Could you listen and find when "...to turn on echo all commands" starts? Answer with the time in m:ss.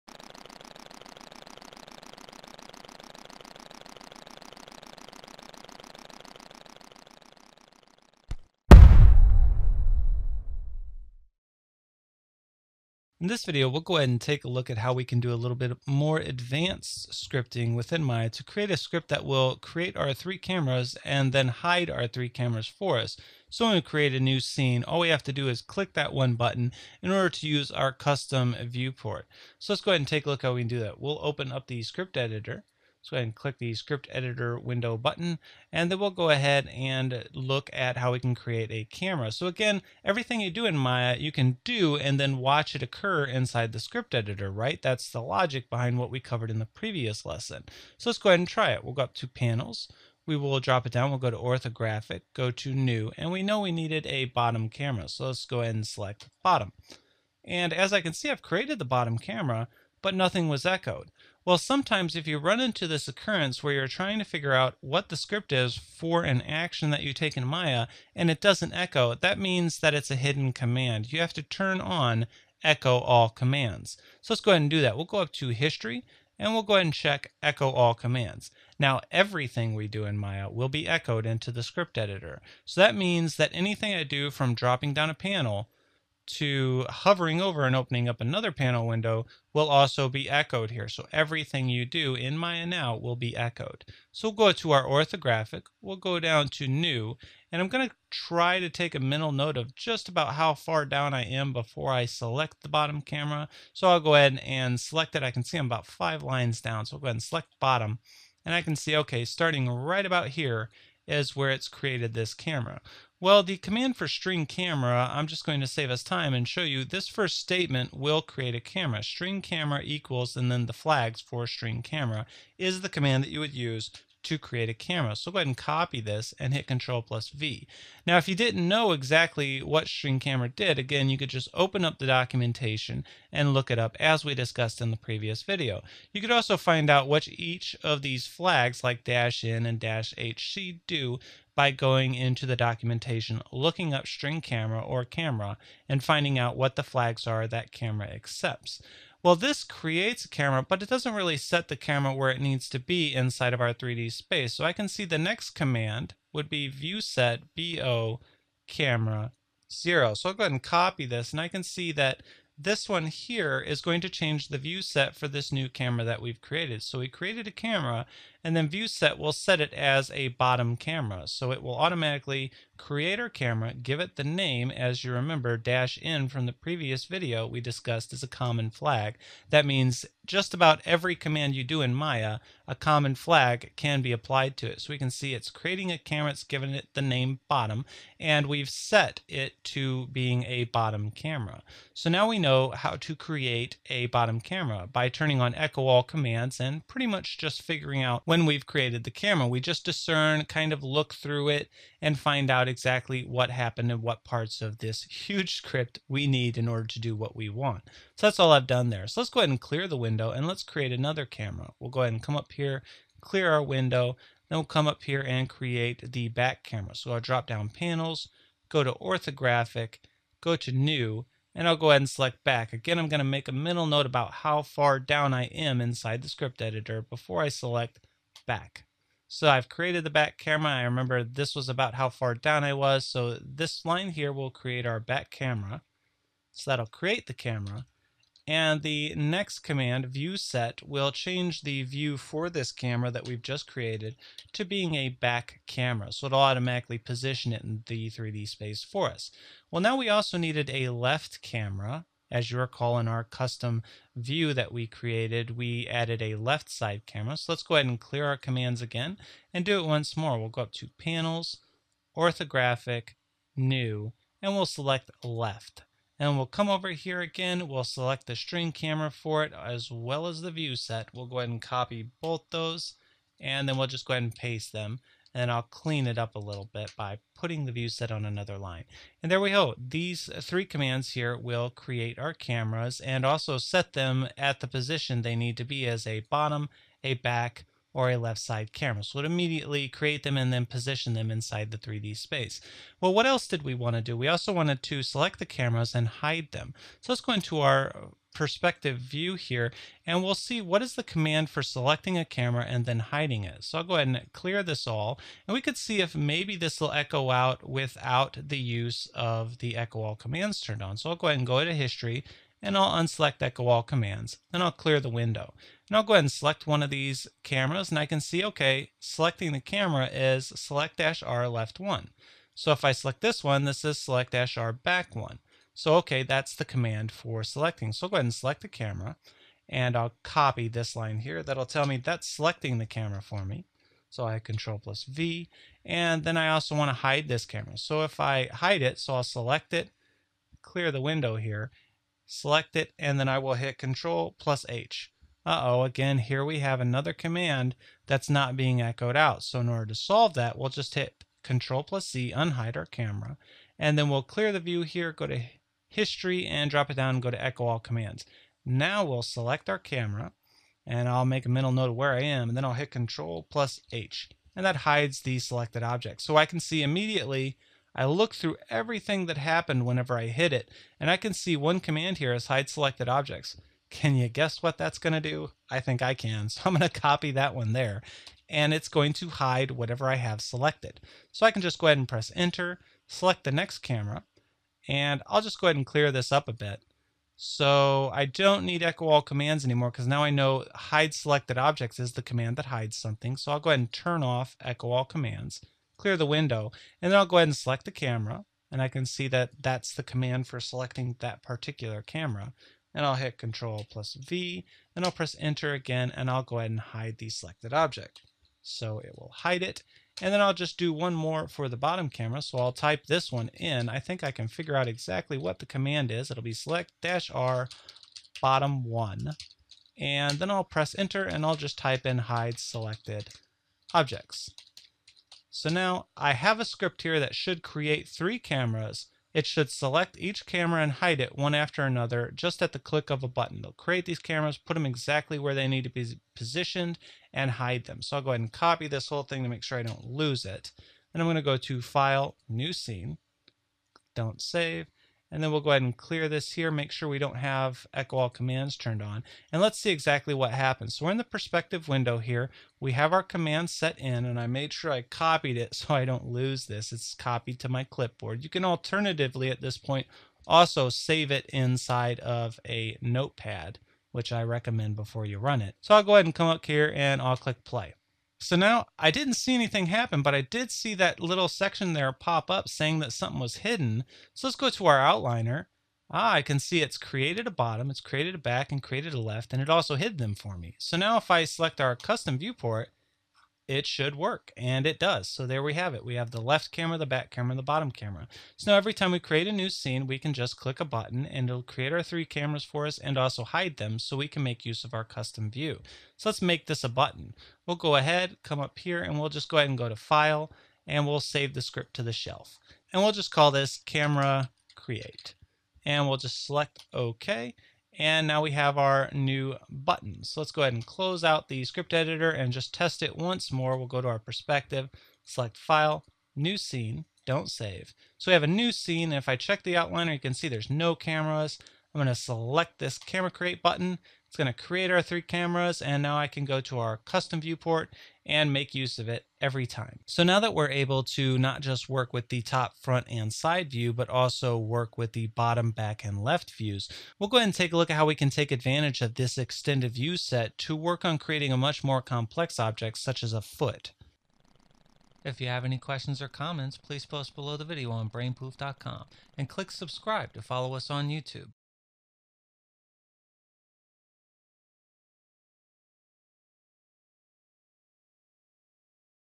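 1:11.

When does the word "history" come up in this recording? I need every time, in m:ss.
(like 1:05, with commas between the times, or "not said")
1:15, 5:11, 5:55.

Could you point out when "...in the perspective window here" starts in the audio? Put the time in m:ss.
7:31.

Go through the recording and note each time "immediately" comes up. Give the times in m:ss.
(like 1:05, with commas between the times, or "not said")
4:49, 6:06.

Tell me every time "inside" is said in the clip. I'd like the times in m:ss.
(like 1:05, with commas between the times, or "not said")
0:43, 2:33, 3:45, 4:51, 7:41.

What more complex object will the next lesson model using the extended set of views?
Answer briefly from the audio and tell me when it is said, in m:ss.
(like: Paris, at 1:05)
A foot, at 9:03.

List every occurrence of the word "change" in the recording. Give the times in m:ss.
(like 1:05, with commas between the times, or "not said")
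2:44, 4:01.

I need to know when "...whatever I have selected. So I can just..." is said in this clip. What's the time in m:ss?
6:19.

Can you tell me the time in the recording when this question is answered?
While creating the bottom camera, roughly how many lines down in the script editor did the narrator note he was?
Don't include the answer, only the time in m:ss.
1:45.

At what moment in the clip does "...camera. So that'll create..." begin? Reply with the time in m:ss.
3:55.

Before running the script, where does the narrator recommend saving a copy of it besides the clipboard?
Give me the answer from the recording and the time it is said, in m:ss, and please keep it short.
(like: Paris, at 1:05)
Notepad, at 7:43.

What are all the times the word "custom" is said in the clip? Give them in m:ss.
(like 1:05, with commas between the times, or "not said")
0:27, 4:13, 8:01, 8:15, 8:46.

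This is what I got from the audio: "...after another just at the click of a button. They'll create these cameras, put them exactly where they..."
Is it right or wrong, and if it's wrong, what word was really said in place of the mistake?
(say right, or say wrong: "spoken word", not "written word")
right.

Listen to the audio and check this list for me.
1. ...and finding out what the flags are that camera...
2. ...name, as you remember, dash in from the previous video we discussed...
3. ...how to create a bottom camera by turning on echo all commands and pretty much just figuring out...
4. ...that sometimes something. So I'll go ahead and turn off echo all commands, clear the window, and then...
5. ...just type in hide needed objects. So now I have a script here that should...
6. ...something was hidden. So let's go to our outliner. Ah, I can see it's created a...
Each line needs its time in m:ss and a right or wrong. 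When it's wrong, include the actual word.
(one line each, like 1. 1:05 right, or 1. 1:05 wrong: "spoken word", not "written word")
1. 2:25 right
2. 2:54 right
3. 3:12 right
4. 6:32 wrong: "hides", not "sometimes"
5. 7:01 wrong: "selected", not "needed"
6. 7:53 right.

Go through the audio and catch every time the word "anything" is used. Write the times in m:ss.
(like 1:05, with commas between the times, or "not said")
1:23, 7:49.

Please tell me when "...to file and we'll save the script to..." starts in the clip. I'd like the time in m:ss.
8:19.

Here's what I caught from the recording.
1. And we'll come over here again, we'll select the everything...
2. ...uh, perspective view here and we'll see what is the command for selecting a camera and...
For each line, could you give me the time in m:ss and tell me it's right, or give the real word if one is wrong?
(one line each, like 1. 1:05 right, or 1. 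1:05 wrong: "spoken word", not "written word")
1. 4:26 wrong: "string", not "everything"
2. 4:57 right.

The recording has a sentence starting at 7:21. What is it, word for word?
Then I'm going to go to File, New Scene.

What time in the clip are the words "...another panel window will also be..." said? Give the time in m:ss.
1:28.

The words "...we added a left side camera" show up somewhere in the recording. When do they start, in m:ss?
4:15.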